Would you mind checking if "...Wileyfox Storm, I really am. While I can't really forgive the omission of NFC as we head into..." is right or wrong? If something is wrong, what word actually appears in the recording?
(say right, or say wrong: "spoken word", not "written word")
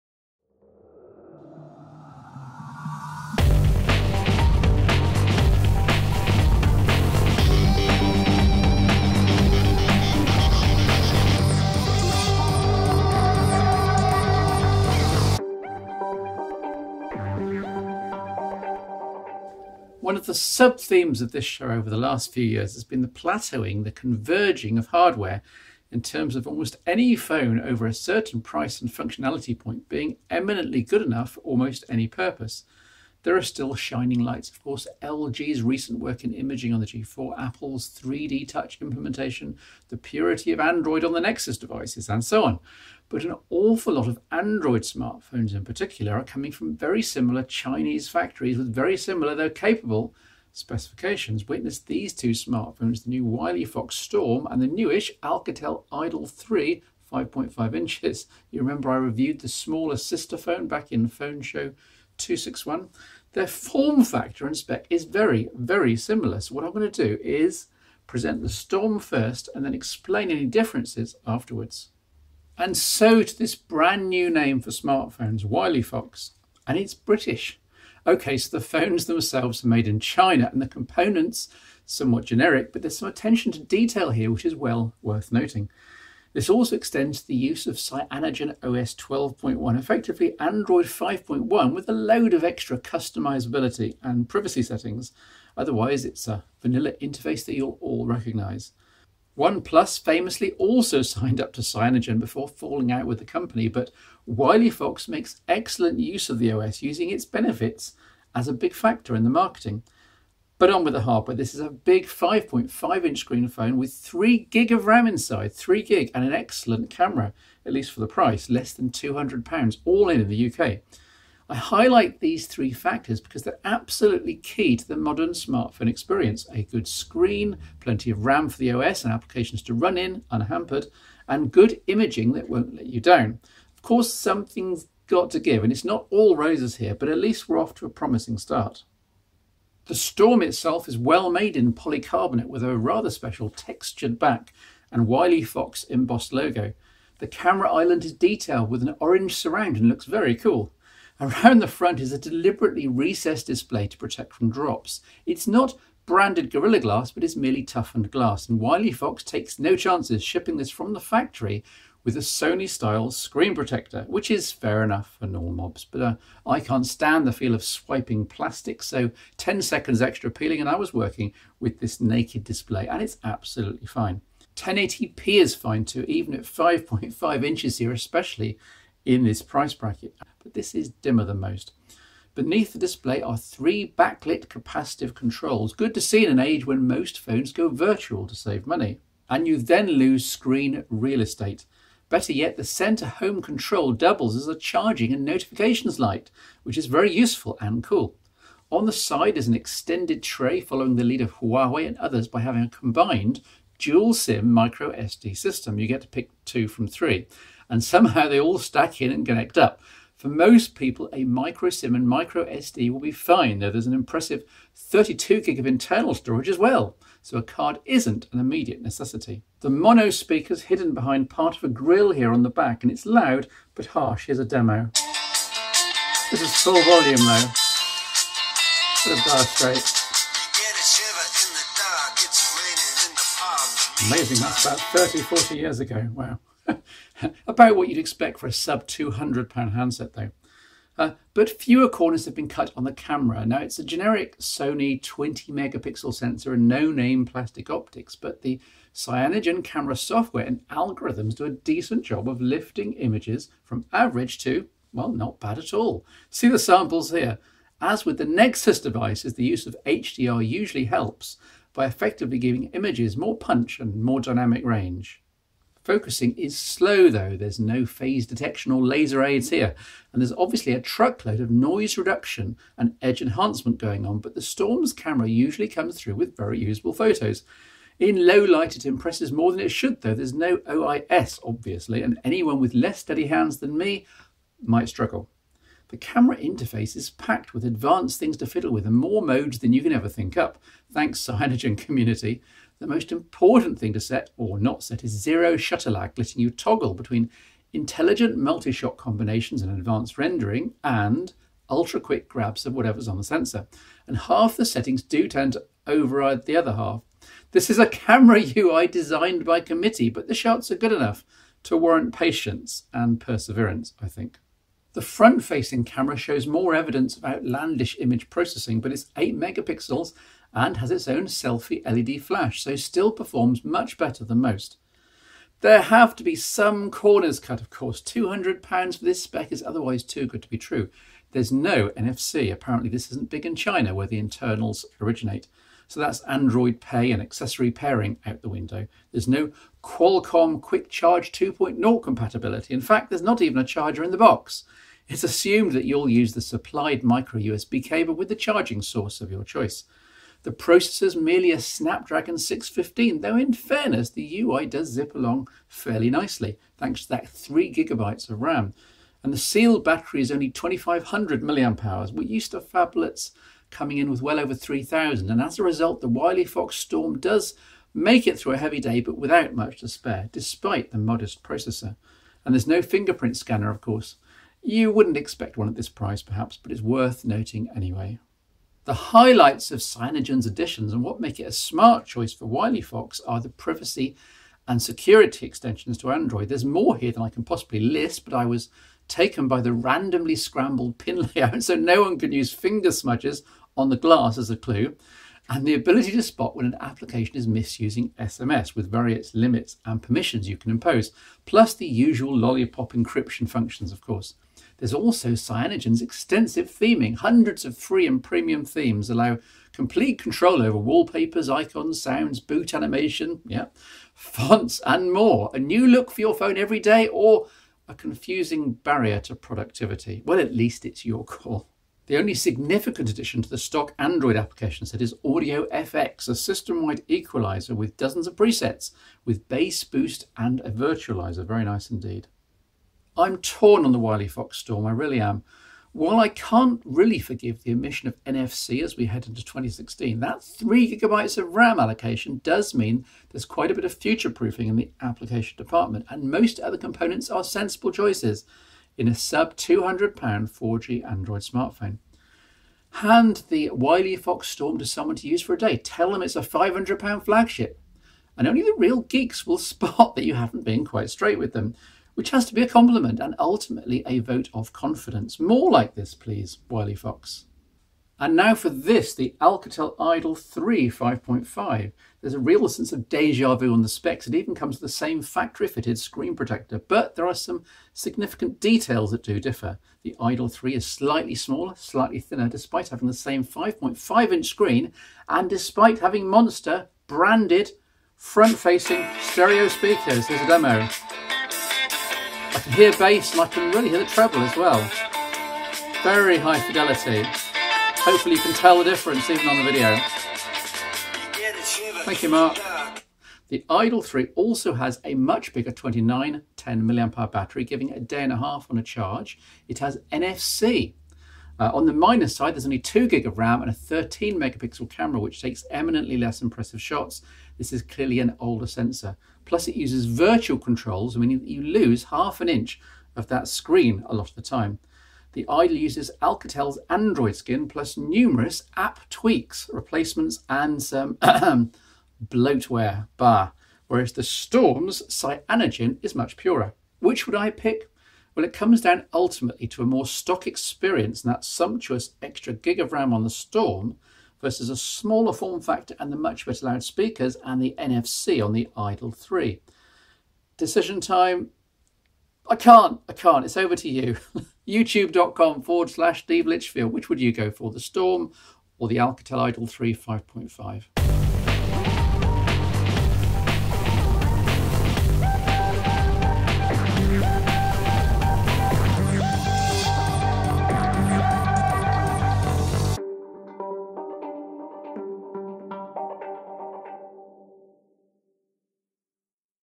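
right.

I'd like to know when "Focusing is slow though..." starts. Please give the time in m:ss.
4:25.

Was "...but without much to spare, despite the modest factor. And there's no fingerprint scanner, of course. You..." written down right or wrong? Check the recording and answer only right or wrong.
wrong.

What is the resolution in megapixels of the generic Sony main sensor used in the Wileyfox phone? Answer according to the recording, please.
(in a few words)
20 megapixels.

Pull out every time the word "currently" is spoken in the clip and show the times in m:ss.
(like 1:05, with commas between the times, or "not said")
not said.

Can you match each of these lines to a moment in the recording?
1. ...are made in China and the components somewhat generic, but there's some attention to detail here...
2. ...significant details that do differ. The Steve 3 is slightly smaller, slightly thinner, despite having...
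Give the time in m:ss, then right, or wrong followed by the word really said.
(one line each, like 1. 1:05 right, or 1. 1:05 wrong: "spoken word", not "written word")
1. 1:19 right
2. 7:57 wrong: "Idol", not "Steve".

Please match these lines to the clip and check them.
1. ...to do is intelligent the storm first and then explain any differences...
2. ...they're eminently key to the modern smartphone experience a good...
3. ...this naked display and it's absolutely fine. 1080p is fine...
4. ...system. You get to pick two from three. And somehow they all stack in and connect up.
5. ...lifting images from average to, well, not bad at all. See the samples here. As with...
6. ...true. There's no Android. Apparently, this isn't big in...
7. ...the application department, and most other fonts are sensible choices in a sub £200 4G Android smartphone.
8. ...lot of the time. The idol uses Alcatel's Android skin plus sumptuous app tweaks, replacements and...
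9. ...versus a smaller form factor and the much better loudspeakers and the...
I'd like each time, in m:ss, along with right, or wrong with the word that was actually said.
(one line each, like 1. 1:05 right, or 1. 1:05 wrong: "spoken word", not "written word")
1. 1:06 wrong: "present", not "intelligent"
2. 2:03 wrong: "absolutely", not "eminently"
3. 2:51 right
4. 3:25 right
5. 4:12 right
6. 5:30 wrong: "NFC", not "Android"
7. 7:24 wrong: "components", not "fonts"
8. 8:44 wrong: "numerous", not "sumptuous"
9. 9:04 right.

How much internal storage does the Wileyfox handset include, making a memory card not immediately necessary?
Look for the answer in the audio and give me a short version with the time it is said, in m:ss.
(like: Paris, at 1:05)
32 GB, at 3:34.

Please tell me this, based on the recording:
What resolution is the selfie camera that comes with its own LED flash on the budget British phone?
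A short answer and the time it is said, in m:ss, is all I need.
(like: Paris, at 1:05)
8 megapixels, at 5:19.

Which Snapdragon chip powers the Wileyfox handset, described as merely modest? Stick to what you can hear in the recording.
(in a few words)
Snapdragon 615.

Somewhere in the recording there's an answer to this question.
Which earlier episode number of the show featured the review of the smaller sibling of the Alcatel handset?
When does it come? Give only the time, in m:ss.
1:01.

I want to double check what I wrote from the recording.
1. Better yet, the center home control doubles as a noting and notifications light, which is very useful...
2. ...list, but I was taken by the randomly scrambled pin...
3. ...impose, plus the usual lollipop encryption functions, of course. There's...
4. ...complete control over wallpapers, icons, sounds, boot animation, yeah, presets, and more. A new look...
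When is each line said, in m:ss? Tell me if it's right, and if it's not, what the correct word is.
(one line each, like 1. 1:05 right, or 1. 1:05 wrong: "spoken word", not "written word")
1. 3:12 wrong: "charging", not "noting"
2. 6:27 right
3. 6:40 right
4. 6:49 wrong: "fonts", not "presets".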